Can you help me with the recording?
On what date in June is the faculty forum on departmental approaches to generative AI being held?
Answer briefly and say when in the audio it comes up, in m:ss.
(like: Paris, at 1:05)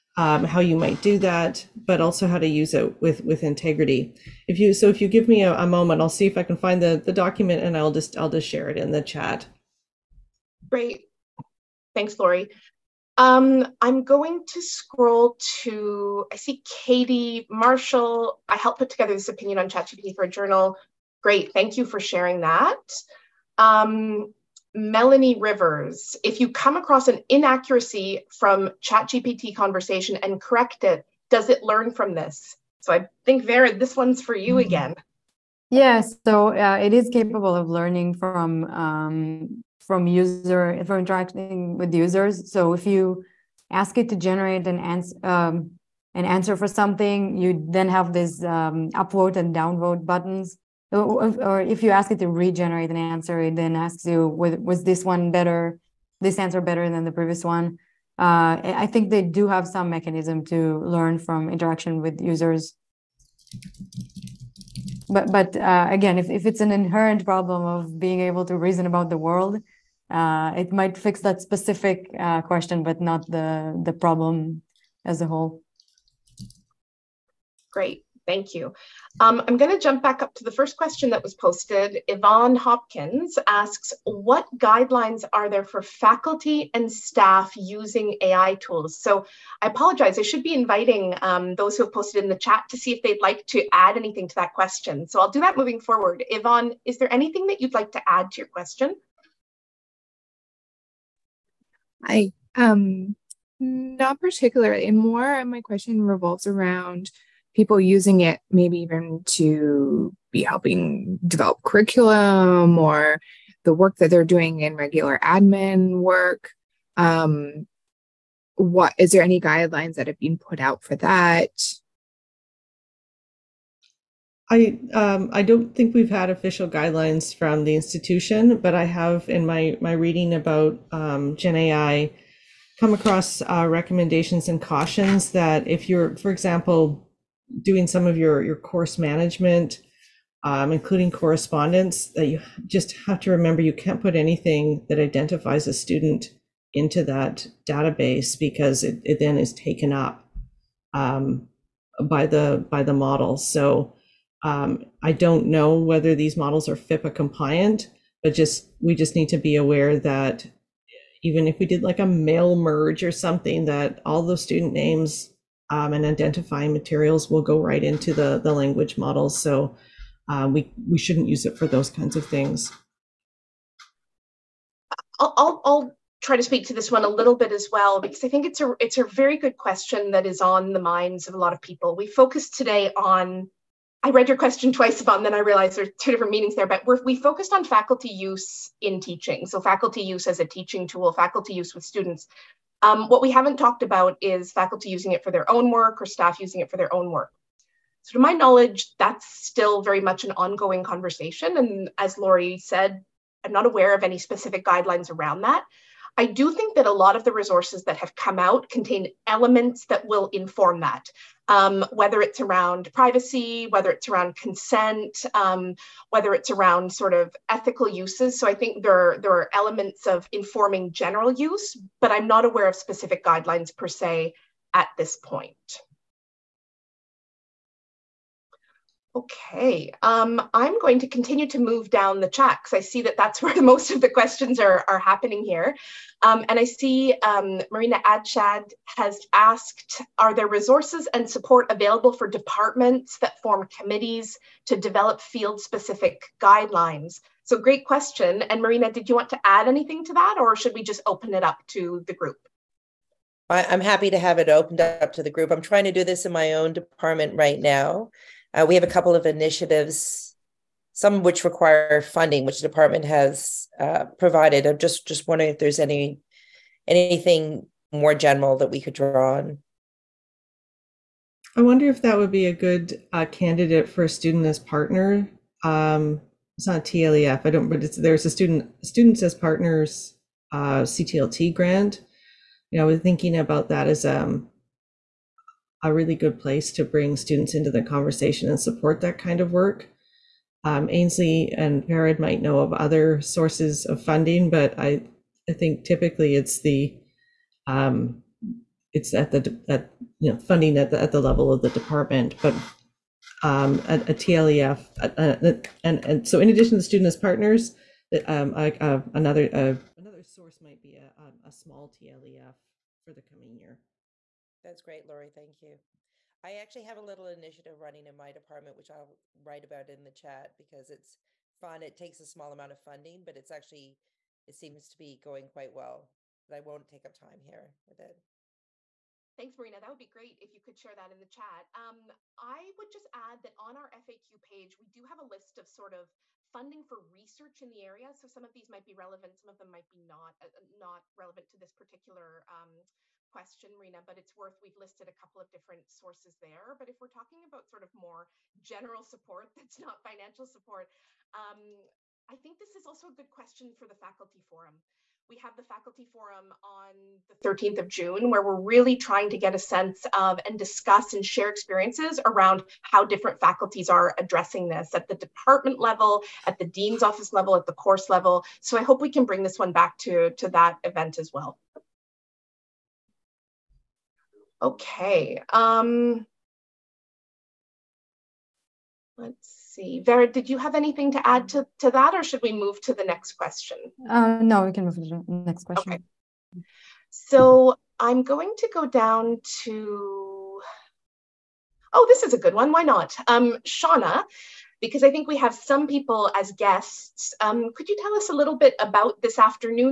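June 13, at 5:57.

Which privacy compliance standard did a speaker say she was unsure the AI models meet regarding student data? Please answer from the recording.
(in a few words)
FIPPA.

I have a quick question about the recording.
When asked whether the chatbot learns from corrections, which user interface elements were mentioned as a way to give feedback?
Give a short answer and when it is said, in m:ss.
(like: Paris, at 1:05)
upvote and downvote buttons, at 0:48.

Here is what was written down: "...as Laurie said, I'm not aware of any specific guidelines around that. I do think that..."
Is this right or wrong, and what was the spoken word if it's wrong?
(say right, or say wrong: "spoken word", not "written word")
right.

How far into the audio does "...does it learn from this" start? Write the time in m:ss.
0:31.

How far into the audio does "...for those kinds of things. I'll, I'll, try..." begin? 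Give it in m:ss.
2:51.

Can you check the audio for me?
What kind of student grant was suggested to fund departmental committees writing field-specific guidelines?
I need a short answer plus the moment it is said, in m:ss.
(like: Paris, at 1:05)
students as partners, at 4:38.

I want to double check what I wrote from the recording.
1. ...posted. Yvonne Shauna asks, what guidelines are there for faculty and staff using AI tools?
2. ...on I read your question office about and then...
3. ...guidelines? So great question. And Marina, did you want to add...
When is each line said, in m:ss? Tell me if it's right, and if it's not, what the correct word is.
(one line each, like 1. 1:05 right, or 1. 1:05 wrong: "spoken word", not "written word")
1. 1:21 wrong: "Hopkins", not "Shauna"
2. 3:02 wrong: "twice", not "office"
3. 4:06 right.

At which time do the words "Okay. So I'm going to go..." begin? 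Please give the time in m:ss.
6:25.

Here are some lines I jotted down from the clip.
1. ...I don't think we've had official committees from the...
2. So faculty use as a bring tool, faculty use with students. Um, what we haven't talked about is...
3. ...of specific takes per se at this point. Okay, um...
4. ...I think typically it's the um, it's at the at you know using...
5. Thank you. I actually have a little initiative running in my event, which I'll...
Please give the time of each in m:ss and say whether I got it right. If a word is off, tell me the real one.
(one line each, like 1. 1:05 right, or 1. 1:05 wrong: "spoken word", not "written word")
1. 2:05 wrong: "guidelines", not "committees"
2. 3:09 wrong: "teaching", not "bring"
3. 3:42 wrong: "guidelines", not "takes"
4. 4:55 wrong: "funding", not "using"
5. 5:15 wrong: "department", not "event".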